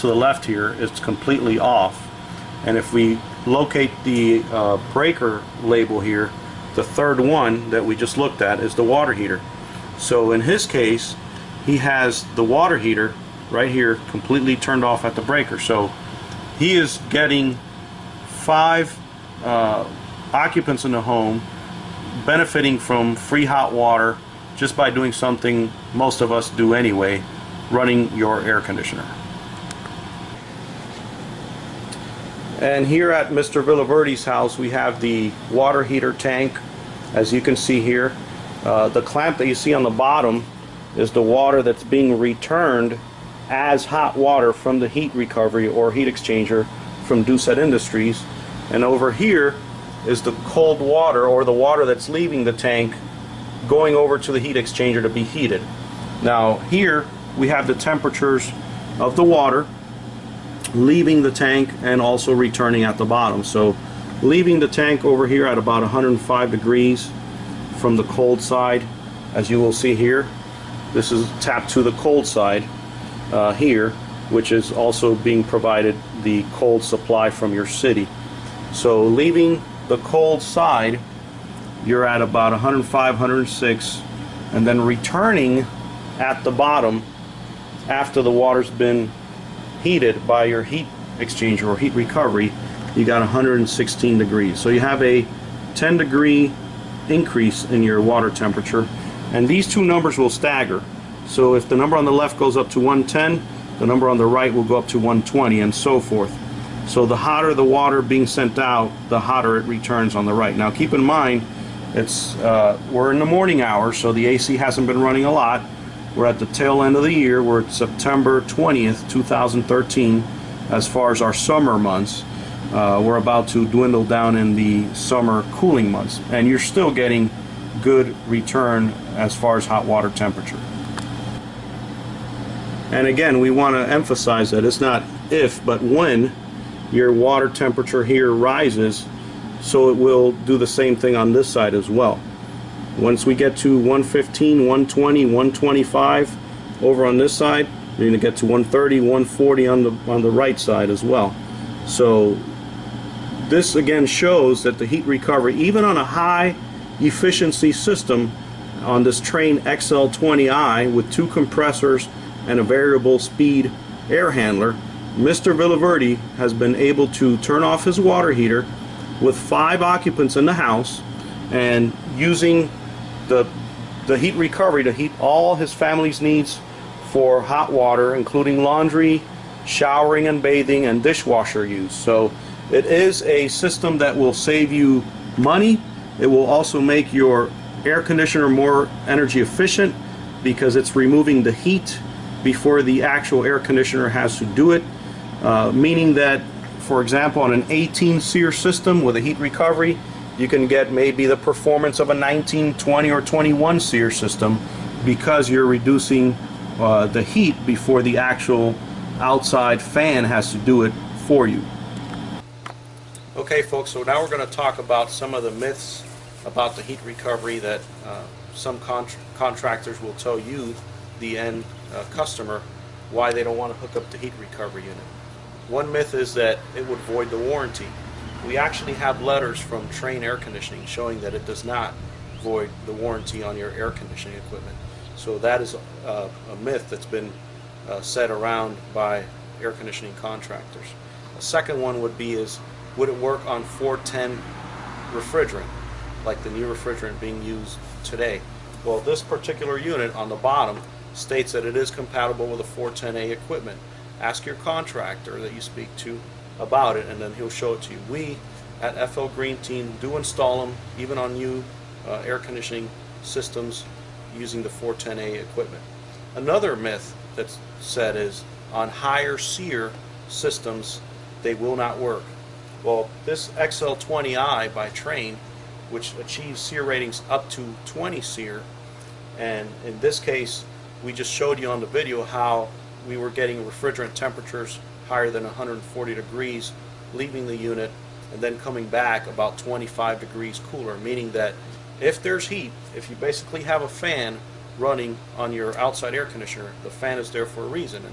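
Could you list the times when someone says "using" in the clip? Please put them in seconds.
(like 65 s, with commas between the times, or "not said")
172 s, 264 s.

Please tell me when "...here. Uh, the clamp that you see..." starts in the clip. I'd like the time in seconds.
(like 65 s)
37 s.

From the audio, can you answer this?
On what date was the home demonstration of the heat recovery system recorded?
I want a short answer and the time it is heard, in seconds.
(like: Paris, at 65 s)
September 20th, 2013, at 117 s.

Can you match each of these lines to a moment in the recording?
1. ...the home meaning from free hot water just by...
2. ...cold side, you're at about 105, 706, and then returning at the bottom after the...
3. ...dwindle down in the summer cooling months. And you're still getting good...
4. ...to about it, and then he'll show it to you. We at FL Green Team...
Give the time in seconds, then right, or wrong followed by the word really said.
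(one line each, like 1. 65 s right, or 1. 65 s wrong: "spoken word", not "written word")
1. 20 s wrong: "benefiting", not "meaning"
2. 79 s wrong: "106", not "706"
3. 123 s right
4. 255 s right.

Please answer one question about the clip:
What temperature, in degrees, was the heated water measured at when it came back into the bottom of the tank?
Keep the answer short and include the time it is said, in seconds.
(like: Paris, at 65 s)
116, at 93 s.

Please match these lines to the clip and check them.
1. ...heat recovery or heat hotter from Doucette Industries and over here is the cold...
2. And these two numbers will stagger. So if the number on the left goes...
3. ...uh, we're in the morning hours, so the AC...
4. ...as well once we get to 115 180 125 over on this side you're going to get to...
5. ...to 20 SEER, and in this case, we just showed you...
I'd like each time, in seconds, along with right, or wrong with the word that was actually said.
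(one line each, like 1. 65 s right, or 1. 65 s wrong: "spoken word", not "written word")
1. 44 s wrong: "exchanger", not "hotter"
2. 99 s right
3. 112 s right
4. 141 s wrong: "120", not "180"
5. 277 s right.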